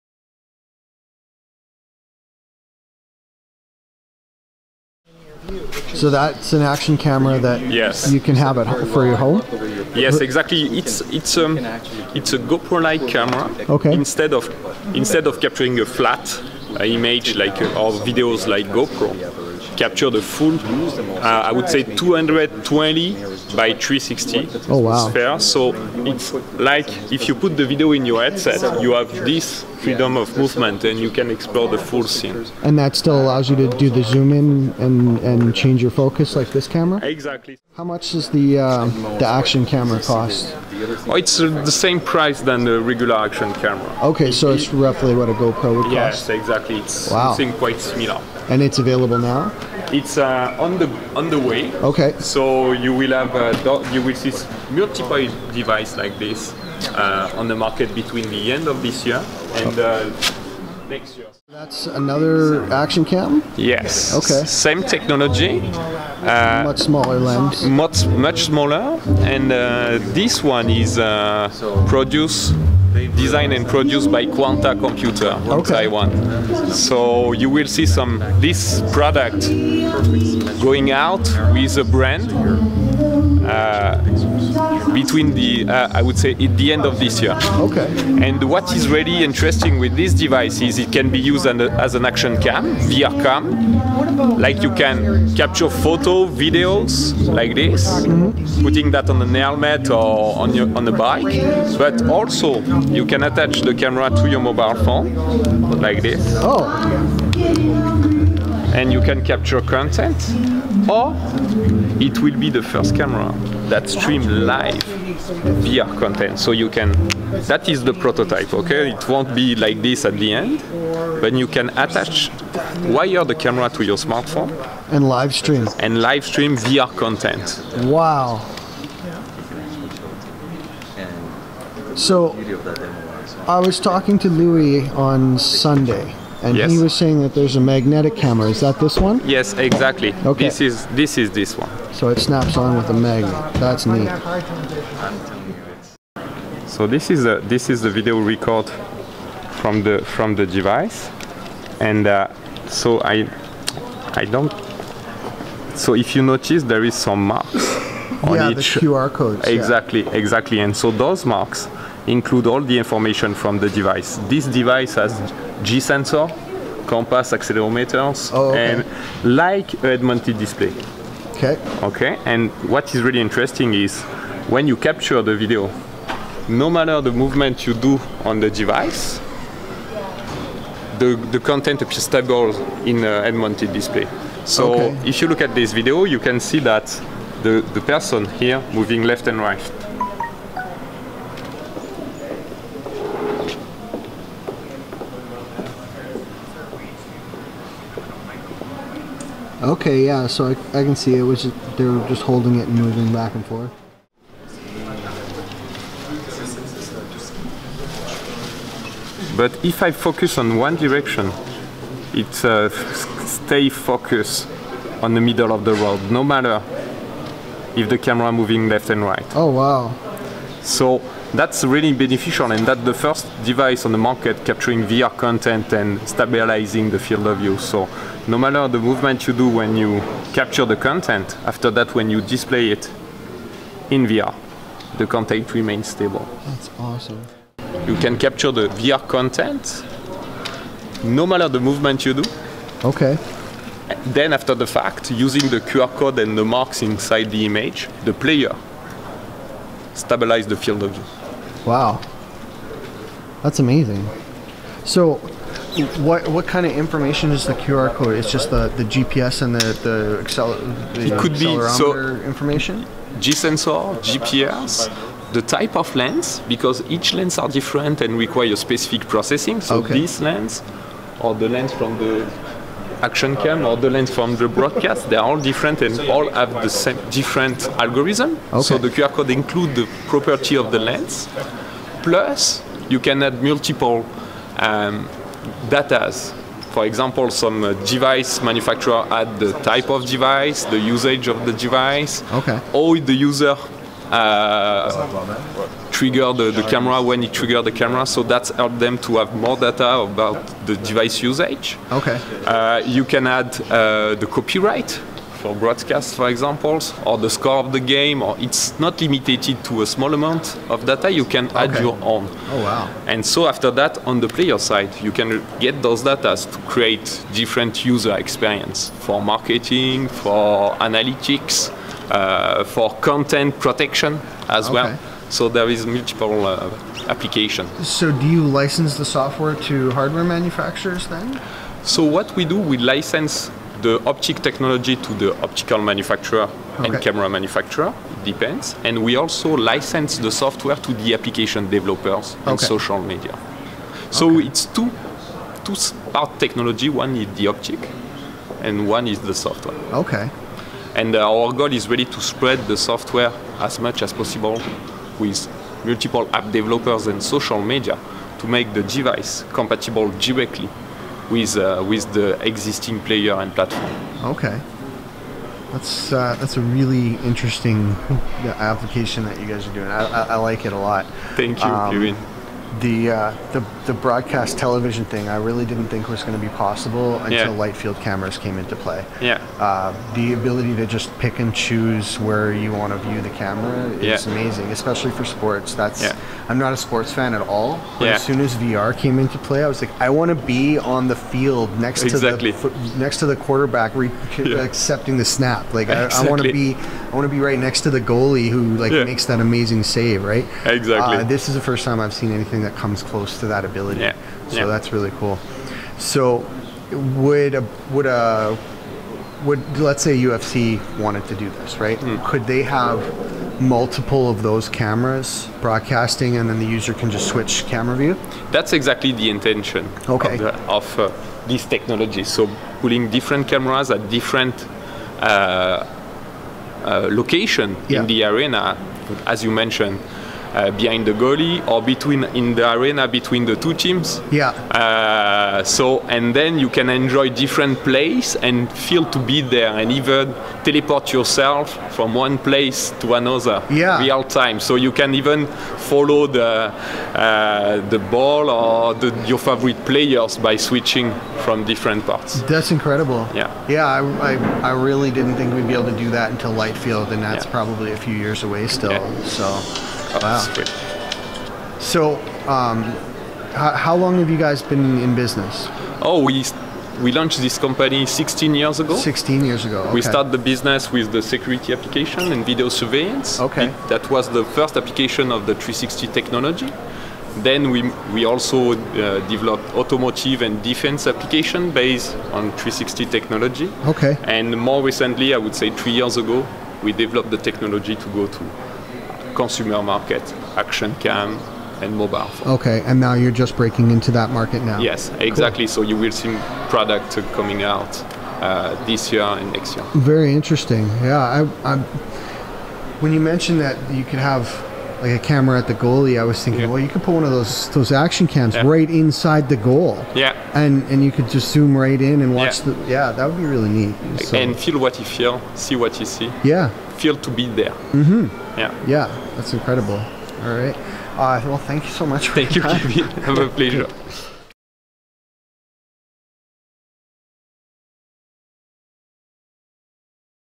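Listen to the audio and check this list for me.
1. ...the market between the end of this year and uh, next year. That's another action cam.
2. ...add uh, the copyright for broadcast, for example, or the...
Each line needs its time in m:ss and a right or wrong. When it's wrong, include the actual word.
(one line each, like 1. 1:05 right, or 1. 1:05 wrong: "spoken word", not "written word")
1. 0:57 right
2. 5:03 right.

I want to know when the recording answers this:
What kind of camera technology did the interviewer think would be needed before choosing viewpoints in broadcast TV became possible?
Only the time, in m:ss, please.
6:17.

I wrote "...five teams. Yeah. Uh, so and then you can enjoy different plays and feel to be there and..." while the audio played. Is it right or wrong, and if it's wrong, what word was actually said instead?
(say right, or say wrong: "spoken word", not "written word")
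wrong: "two", not "five".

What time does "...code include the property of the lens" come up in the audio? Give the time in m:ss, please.
4:39.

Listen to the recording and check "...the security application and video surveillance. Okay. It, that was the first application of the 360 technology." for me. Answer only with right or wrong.
right.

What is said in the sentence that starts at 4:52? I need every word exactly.
or the user uh, trigger the, the camera when it triggers the camera.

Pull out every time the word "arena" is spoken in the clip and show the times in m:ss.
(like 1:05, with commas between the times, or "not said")
7:08, 7:12.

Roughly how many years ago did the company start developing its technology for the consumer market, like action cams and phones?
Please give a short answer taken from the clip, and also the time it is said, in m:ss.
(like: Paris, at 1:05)
3, at 8:05.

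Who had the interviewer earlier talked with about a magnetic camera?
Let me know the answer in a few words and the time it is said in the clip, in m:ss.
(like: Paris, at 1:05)
Louis, at 2:14.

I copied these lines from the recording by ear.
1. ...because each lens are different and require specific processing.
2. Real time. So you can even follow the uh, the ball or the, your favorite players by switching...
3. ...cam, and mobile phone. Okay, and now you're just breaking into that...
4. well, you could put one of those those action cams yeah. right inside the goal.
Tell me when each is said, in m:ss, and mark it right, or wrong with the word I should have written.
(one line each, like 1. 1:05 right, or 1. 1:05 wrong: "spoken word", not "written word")
1. 4:26 right
2. 7:23 right
3. 8:10 right
4. 8:26 right.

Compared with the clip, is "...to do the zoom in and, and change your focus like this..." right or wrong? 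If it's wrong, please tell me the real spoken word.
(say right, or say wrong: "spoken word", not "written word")
right.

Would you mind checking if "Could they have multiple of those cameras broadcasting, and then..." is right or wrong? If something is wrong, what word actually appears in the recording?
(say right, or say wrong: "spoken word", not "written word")
right.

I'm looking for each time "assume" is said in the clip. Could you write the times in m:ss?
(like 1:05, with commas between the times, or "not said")
not said.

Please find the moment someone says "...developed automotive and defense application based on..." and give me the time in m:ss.
7:59.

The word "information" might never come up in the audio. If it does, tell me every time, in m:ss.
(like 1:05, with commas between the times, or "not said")
2:42, 4:16, 4:22.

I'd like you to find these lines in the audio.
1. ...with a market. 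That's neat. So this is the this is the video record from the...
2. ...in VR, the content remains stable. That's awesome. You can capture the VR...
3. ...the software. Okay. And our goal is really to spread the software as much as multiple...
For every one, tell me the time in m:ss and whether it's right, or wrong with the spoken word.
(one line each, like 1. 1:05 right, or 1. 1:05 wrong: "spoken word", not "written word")
1. 2:22 wrong: "magnet", not "market"
2. 3:53 right
3. 5:49 wrong: "possible", not "multiple".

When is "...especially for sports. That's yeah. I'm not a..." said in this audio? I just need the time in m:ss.
6:24.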